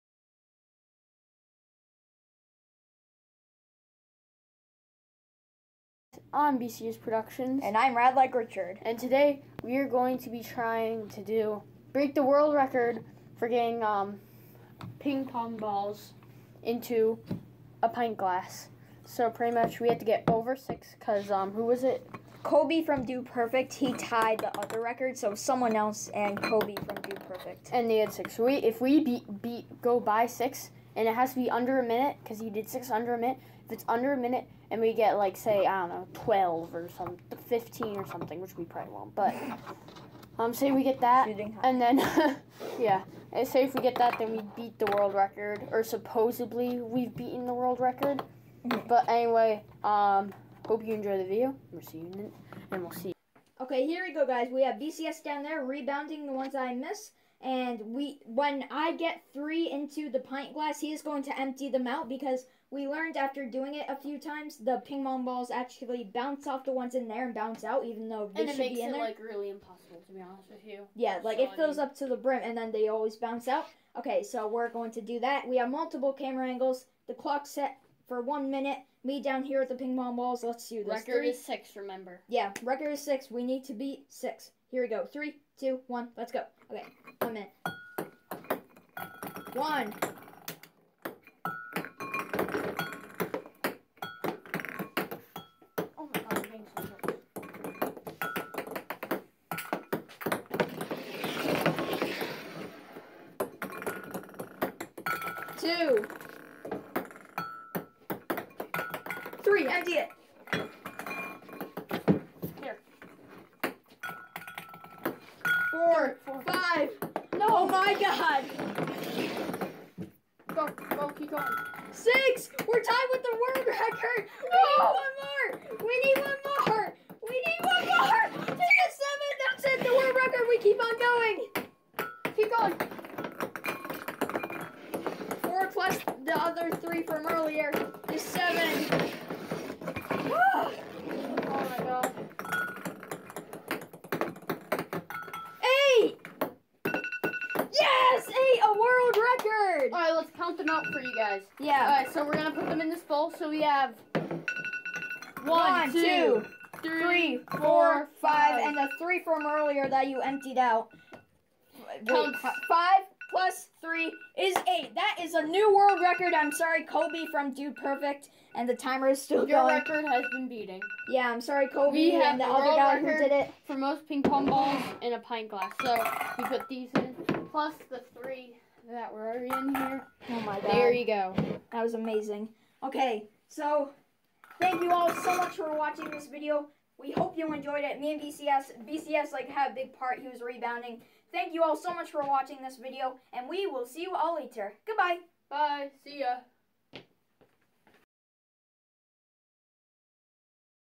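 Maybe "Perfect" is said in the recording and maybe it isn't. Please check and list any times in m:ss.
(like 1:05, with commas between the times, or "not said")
0:23, 0:27, 2:47.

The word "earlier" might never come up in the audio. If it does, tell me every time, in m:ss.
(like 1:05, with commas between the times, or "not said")
2:17, 2:39.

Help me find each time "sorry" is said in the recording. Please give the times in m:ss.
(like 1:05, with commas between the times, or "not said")
2:46, 2:51.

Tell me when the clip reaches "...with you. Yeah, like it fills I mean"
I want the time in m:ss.
1:10.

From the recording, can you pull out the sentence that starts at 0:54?
We have BCS down there rebounding the ones I miss.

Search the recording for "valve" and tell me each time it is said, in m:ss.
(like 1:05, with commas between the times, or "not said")
not said.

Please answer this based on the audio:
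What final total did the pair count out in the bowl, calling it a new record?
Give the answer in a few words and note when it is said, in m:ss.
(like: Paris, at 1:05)
8, at 2:44.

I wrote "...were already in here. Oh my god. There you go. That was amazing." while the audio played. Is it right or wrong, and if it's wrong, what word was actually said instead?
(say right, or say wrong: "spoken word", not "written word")
right.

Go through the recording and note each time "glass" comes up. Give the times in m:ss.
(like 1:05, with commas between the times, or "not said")
0:18, 1:00, 2:55.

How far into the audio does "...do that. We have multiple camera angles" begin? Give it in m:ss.
1:15.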